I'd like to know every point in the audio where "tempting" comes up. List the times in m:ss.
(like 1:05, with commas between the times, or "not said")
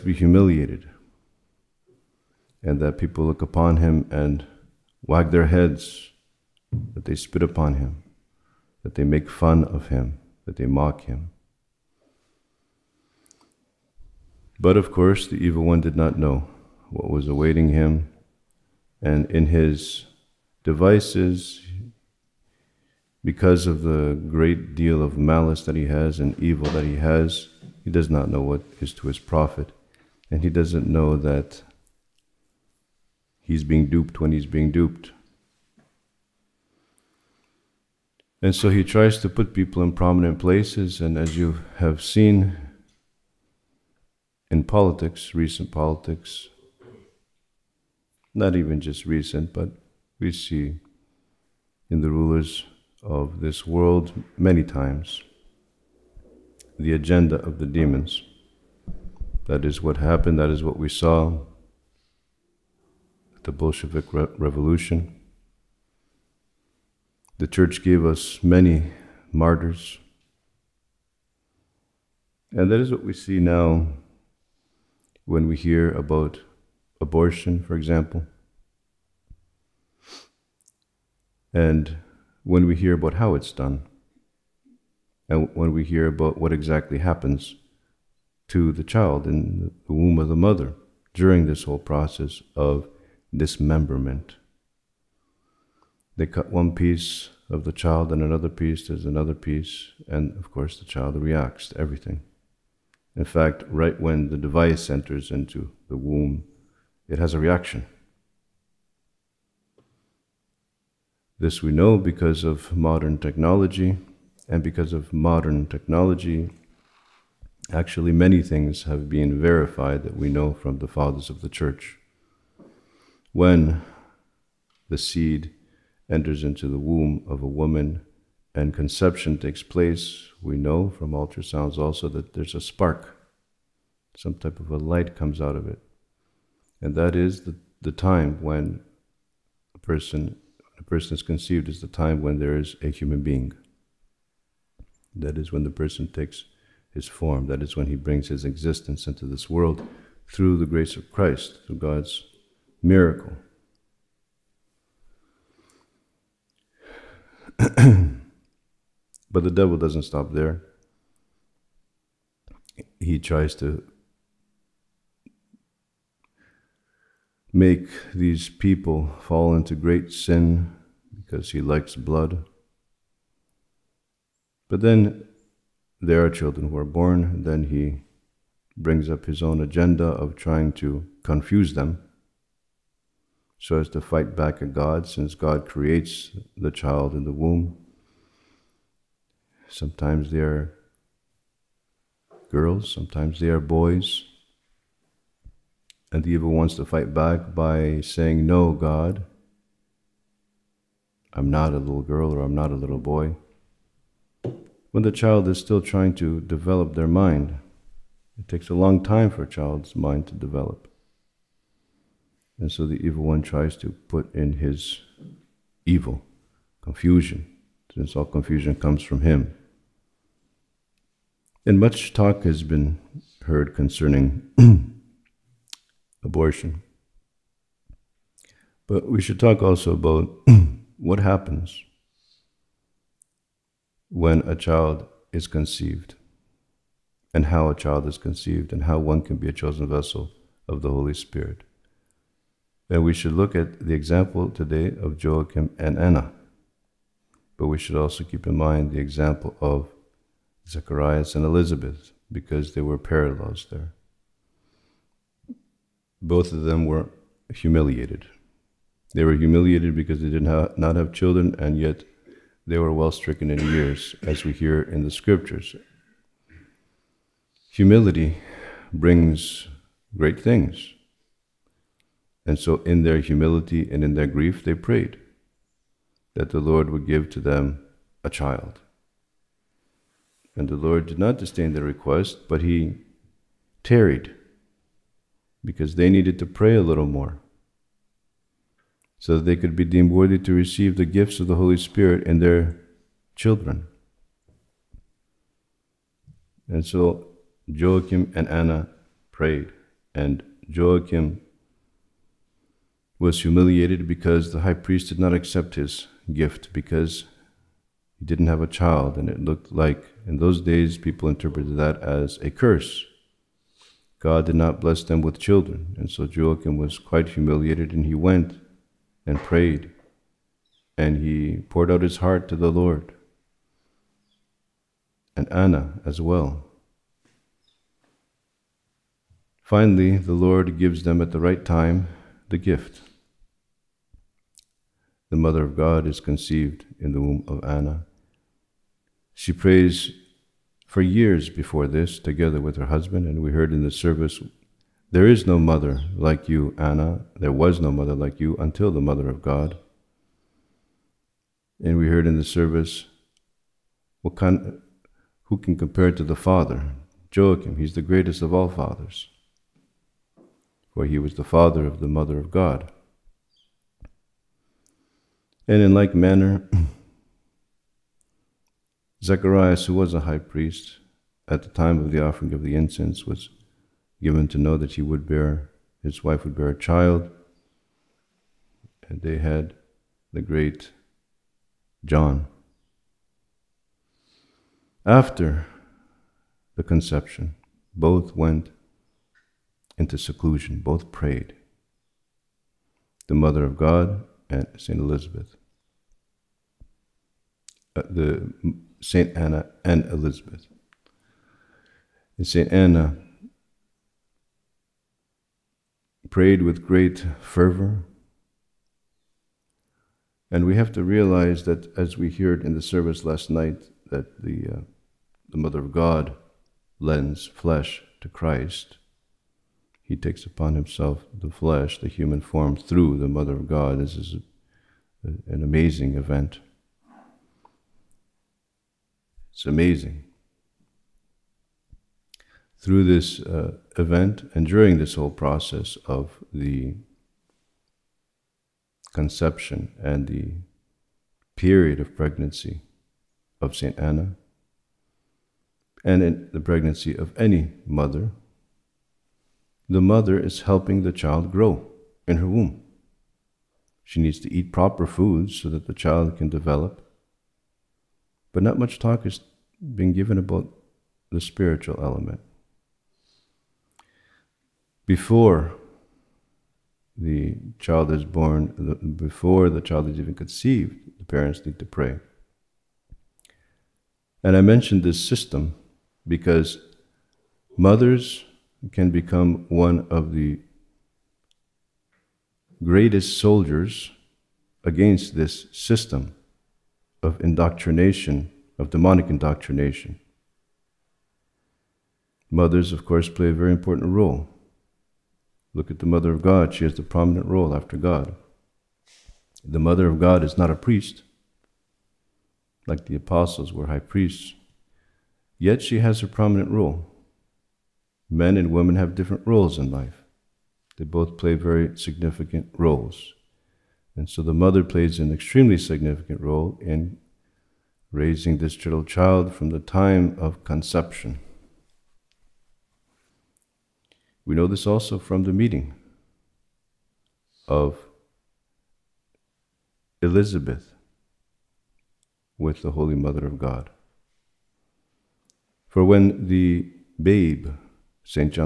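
not said.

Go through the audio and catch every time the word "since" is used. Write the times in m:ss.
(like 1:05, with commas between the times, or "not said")
3:05, 3:37.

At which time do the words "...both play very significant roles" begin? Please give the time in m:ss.
8:31.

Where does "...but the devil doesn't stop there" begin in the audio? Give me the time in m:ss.
2:37.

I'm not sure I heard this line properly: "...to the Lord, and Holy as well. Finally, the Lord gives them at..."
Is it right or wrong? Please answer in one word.
wrong.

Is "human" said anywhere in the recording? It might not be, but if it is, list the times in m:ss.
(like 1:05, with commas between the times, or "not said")
2:22, 7:02.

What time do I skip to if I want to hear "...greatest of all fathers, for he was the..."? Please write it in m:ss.
5:58.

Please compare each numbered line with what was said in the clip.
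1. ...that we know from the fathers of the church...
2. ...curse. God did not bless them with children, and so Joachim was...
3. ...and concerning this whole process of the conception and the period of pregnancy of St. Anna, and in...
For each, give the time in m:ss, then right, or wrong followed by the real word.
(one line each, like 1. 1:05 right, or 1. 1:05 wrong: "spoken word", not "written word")
1. 2:00 right
2. 5:12 right
3. 7:14 wrong: "during", not "concerning".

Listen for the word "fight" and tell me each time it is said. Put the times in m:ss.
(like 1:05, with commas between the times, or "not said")
3:04, 3:16.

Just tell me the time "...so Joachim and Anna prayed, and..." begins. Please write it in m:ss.
4:56.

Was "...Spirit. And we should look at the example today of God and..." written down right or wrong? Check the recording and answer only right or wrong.
wrong.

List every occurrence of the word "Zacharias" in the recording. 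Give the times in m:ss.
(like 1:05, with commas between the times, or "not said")
4:10, 6:09.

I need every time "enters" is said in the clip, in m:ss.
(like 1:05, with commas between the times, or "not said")
1:44, 2:06.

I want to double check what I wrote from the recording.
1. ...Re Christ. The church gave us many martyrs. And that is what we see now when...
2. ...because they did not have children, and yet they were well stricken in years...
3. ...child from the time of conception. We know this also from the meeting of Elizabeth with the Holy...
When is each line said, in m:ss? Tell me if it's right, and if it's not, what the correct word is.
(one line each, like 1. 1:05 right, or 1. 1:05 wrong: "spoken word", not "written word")
1. 1:04 wrong: "Revolution", not "Christ"
2. 4:19 right
3. 8:39 right.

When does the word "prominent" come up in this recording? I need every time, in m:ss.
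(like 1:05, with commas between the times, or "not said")
0:39, 8:17, 8:26.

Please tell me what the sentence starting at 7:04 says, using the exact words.
This is a, an amazing event.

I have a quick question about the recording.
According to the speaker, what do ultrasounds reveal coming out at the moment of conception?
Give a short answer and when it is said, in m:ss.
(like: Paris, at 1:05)
a spark, at 2:12.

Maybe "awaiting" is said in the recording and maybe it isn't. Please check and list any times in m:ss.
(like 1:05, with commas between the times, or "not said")
0:17.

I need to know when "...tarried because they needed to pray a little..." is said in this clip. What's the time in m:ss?
4:43.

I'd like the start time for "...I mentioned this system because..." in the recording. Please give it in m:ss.
7:54.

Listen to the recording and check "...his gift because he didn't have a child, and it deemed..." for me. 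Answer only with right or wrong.
wrong.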